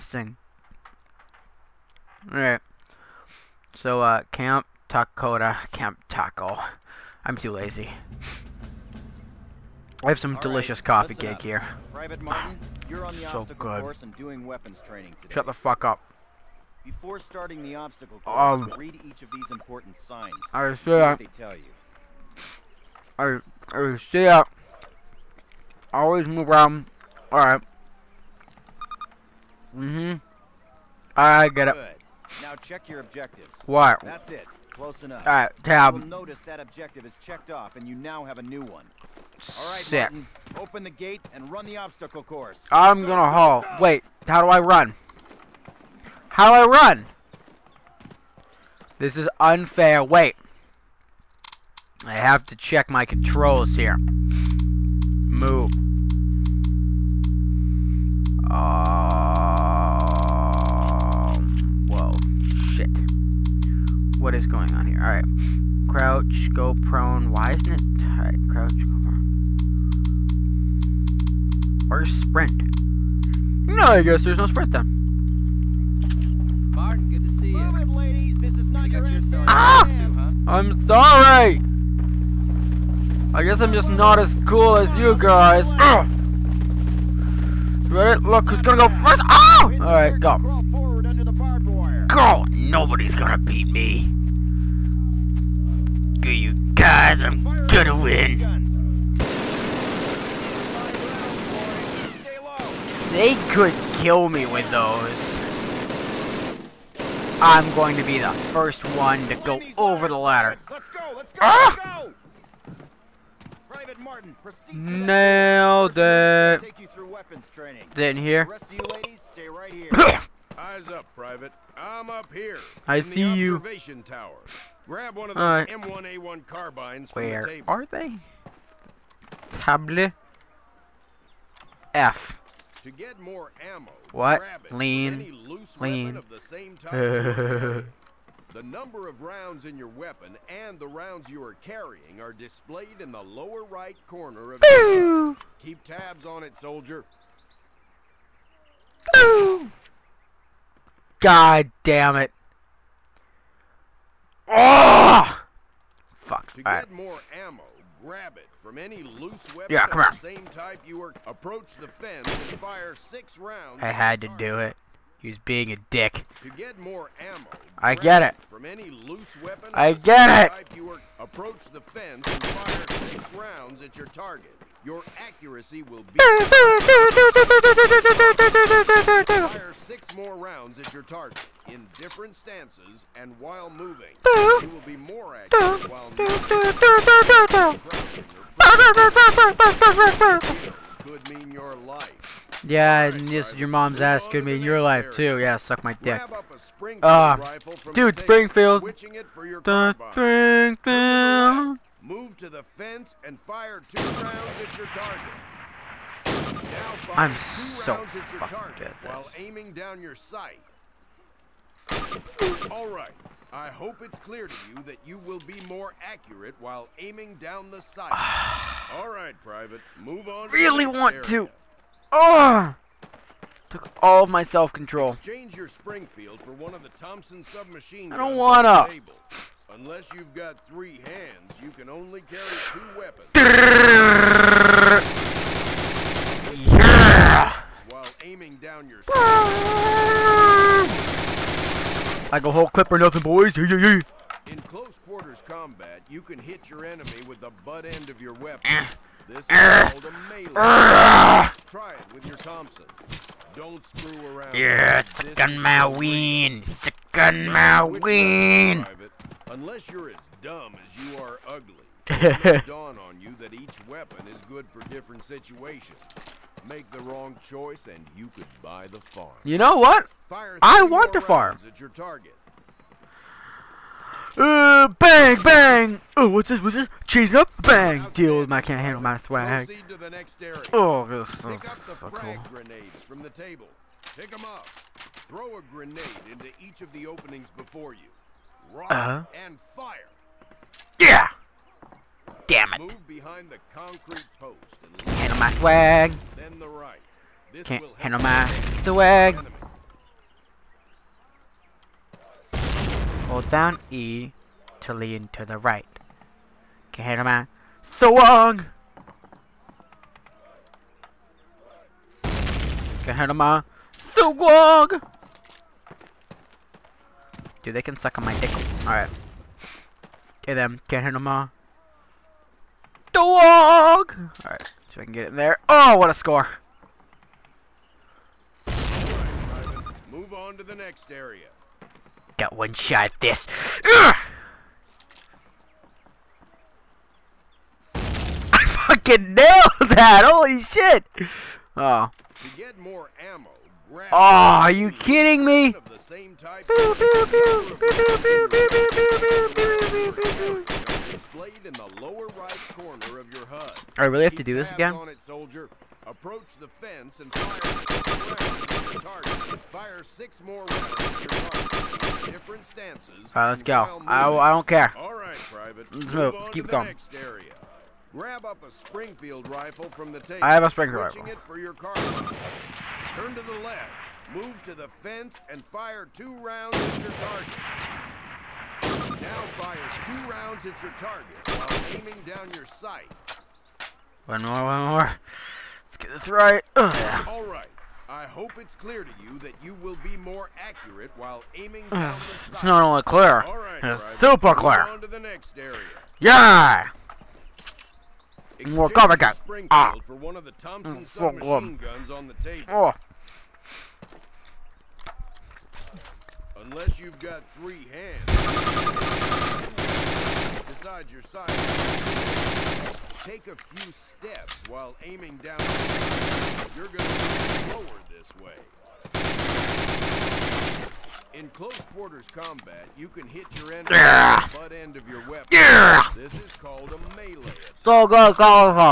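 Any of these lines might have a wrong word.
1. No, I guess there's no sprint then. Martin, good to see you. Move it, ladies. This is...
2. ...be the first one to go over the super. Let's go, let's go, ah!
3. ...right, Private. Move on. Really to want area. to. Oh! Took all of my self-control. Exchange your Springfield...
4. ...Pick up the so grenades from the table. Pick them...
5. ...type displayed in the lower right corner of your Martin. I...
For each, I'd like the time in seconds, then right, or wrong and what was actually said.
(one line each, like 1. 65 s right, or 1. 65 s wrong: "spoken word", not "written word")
1. 73 s right
2. 108 s wrong: "ladder", not "super"
3. 219 s right
4. 281 s right
5. 346 s wrong: "HUD", not "Martin".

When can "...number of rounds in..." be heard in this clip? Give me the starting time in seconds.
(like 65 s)
138 s.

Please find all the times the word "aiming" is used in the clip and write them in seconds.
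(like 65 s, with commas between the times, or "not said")
209 s, 216 s, 238 s, 381 s, 391 s, 415 s.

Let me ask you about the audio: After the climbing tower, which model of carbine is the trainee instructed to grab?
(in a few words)
M1A1.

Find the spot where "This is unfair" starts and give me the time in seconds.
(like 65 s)
48 s.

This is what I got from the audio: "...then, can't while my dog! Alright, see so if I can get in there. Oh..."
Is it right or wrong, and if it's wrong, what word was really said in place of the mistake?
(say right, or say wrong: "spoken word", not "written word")
wrong: "handle", not "while".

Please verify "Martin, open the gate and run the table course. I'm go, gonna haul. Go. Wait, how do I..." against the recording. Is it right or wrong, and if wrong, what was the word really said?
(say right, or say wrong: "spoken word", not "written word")
wrong: "obstacle", not "table".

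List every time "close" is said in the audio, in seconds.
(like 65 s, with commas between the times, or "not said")
34 s, 244 s, 421 s.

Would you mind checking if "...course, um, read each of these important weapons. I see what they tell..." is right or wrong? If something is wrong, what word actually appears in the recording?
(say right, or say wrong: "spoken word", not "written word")
wrong: "signs", not "weapons".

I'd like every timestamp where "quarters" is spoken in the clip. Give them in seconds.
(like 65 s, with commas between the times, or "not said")
245 s, 421 s.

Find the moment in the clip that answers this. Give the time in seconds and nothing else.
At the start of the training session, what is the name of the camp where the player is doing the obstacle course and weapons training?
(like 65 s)
4 s.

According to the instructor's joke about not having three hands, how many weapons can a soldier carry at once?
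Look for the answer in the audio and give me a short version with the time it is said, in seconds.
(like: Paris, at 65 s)
2, at 232 s.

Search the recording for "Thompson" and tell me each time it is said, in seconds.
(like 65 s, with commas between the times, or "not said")
226 s, 252 s, 400 s.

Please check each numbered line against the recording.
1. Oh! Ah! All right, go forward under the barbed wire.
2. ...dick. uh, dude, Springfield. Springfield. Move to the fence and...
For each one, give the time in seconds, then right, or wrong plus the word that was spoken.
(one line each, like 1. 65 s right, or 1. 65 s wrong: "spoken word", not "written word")
1. 89 s right
2. 195 s right.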